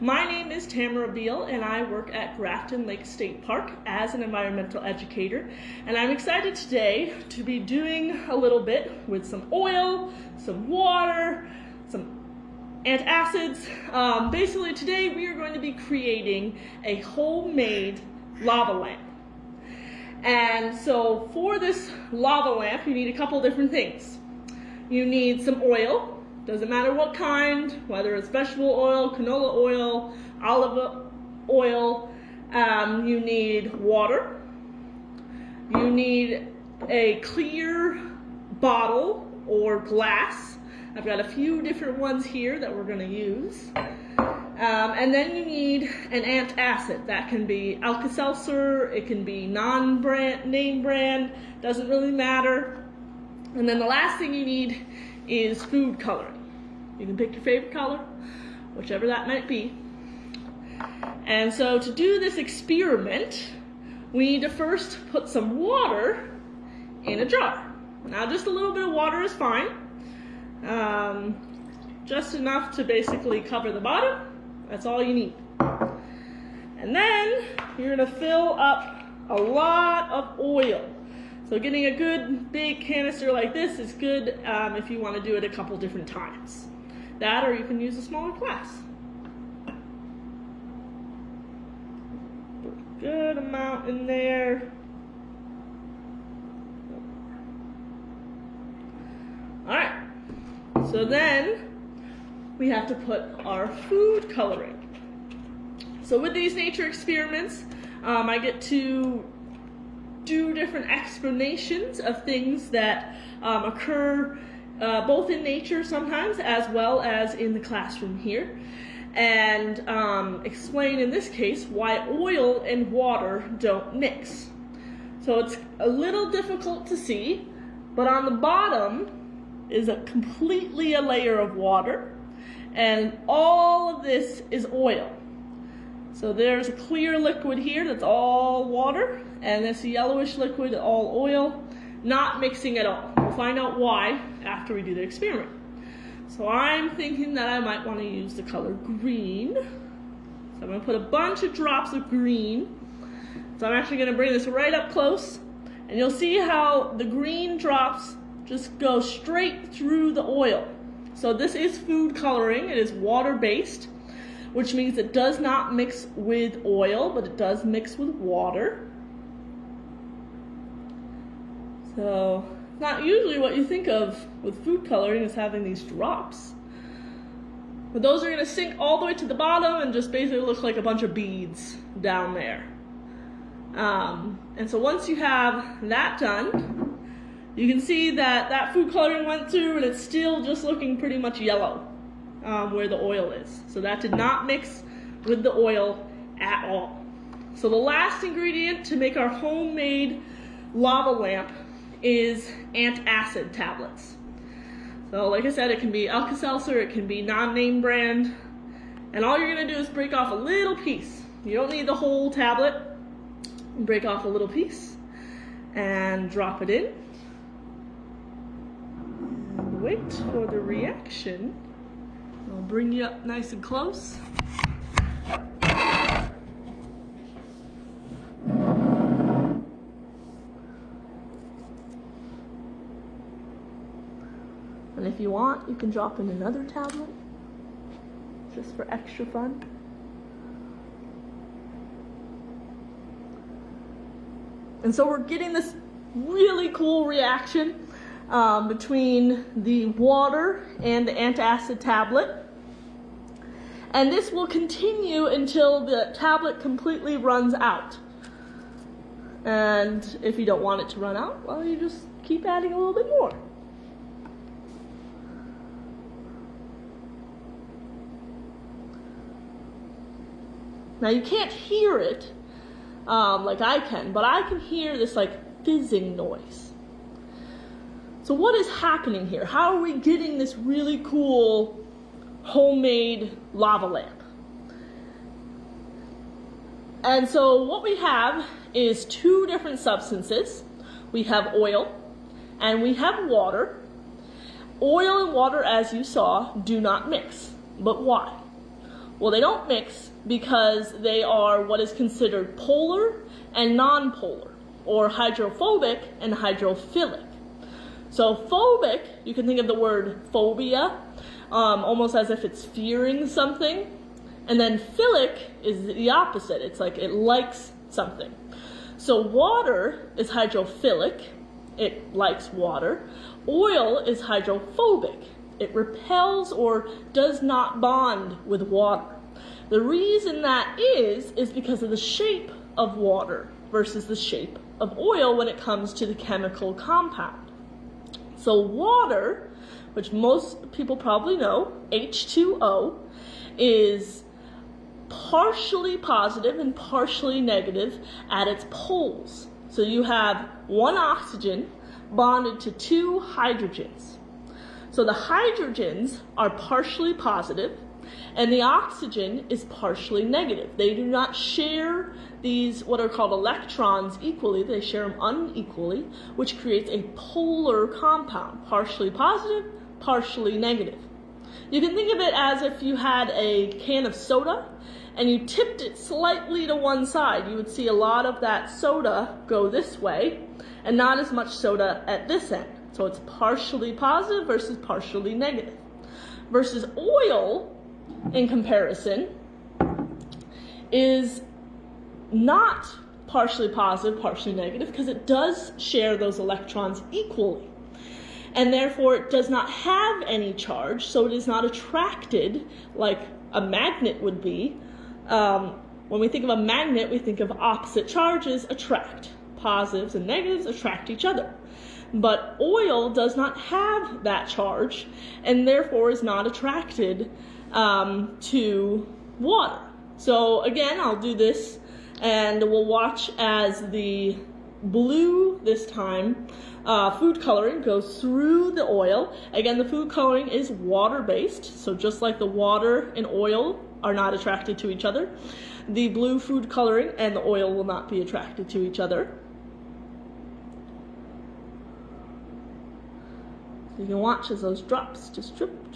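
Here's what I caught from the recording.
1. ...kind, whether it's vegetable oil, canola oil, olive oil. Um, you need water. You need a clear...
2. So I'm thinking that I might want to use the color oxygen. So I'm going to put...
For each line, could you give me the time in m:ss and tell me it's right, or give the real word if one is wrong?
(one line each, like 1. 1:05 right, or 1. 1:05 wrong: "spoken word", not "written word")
1. 0:27 right
2. 2:26 wrong: "green", not "oxygen".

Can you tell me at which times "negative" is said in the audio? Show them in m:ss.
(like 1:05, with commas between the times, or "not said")
5:47, 6:00, 6:10, 6:25, 6:34, 6:50.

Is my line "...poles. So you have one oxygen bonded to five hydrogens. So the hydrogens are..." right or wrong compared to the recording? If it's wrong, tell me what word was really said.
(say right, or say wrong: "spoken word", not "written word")
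wrong: "two", not "five".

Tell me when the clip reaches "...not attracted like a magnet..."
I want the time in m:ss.
6:41.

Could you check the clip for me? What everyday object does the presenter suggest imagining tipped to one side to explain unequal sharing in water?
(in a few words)
a can of soda.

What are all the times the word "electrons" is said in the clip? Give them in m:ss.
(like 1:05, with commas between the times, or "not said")
6:03, 6:36.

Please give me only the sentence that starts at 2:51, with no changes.
So not usually what you think of with food coloring is having these drops.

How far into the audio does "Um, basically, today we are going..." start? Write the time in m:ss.
0:13.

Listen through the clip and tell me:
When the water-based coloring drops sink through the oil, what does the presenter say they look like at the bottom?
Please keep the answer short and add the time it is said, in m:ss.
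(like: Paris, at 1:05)
beads, at 3:01.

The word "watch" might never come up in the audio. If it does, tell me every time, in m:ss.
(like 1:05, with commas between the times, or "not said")
7:02, 7:24.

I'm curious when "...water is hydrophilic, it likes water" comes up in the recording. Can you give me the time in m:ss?
5:19.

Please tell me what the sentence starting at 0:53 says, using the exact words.
And then the last thing you need is food coloring.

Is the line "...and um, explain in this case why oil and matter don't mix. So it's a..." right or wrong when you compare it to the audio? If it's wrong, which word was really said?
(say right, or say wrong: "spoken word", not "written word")
wrong: "water", not "matter".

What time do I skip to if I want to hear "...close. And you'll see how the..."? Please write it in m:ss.
2:34.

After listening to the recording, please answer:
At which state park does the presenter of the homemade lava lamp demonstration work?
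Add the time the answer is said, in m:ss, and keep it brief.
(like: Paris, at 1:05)
Grafton Lake State Park, at 0:02.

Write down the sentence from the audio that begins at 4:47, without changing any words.
And so what we have is two different substances.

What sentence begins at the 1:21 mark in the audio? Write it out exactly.
So getting a good big canister like this is good um, if you want to do it a couple different times.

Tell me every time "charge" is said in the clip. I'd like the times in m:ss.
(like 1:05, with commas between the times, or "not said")
6:40, 6:48, 6:54.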